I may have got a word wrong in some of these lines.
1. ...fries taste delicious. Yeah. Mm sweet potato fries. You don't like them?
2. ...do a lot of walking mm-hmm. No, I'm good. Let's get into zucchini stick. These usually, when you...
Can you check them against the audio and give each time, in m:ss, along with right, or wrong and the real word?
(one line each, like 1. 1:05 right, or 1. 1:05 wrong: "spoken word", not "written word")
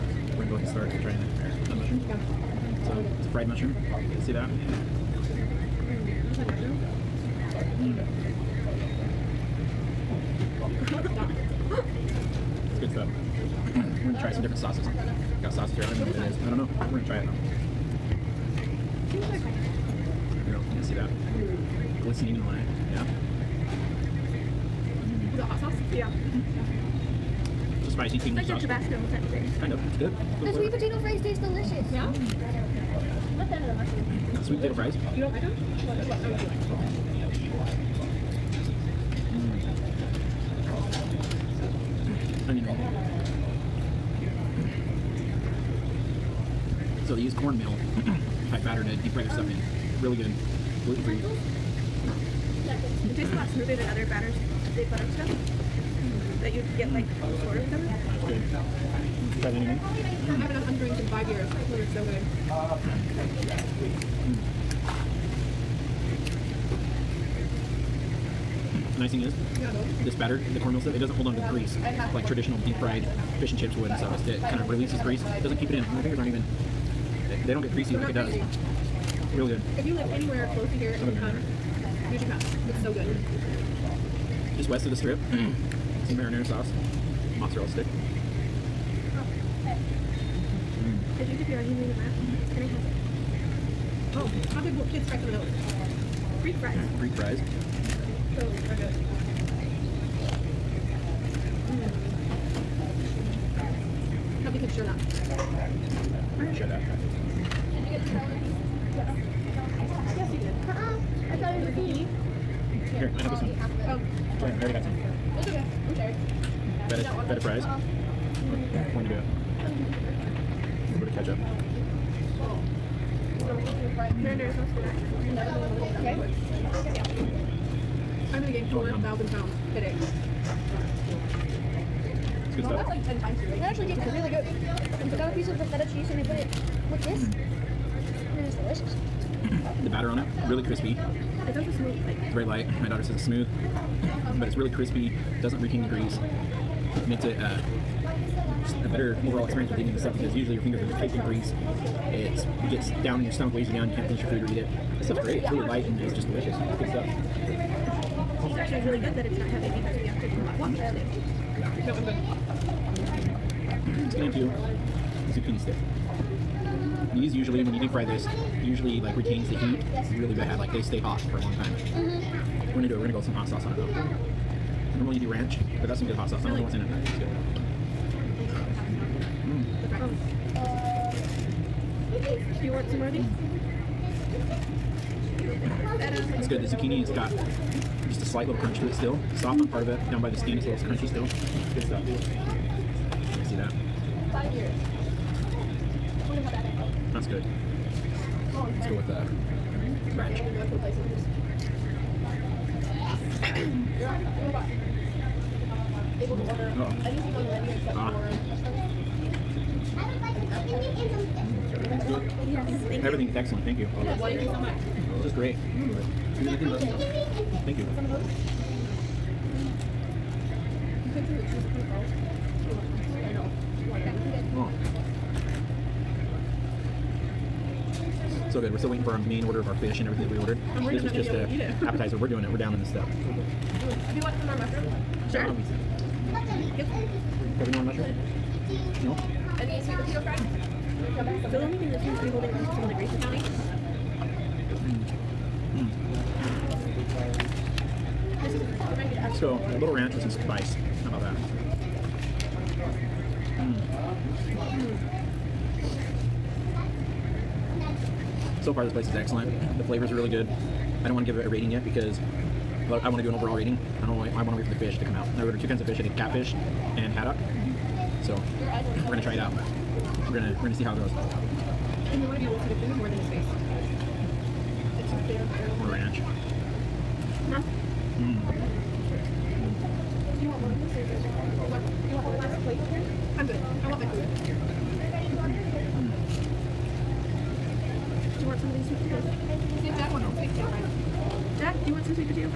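1. 0:31 right
2. 2:40 right.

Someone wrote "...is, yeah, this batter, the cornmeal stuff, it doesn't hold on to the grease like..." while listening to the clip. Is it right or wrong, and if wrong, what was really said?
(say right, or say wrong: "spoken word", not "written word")
right.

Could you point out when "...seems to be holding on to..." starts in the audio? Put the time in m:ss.
4:01.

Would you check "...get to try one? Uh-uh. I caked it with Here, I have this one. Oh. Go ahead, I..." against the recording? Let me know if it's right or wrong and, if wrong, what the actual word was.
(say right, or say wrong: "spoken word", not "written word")
wrong: "tried", not "caked".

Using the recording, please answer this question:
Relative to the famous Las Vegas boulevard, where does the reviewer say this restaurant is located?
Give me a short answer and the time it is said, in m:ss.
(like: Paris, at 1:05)
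Just west of the strip, at 1:24.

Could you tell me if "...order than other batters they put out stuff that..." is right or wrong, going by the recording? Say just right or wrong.
wrong.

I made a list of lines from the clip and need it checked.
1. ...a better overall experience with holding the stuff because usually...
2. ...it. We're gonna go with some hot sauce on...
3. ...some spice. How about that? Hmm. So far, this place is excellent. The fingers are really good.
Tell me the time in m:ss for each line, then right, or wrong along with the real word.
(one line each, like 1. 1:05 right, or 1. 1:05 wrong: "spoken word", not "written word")
1. 2:28 wrong: "eating", not "holding"
2. 2:52 right
3. 4:10 wrong: "flavors", not "fingers".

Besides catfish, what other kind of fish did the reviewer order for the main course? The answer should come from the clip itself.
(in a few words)
haddock.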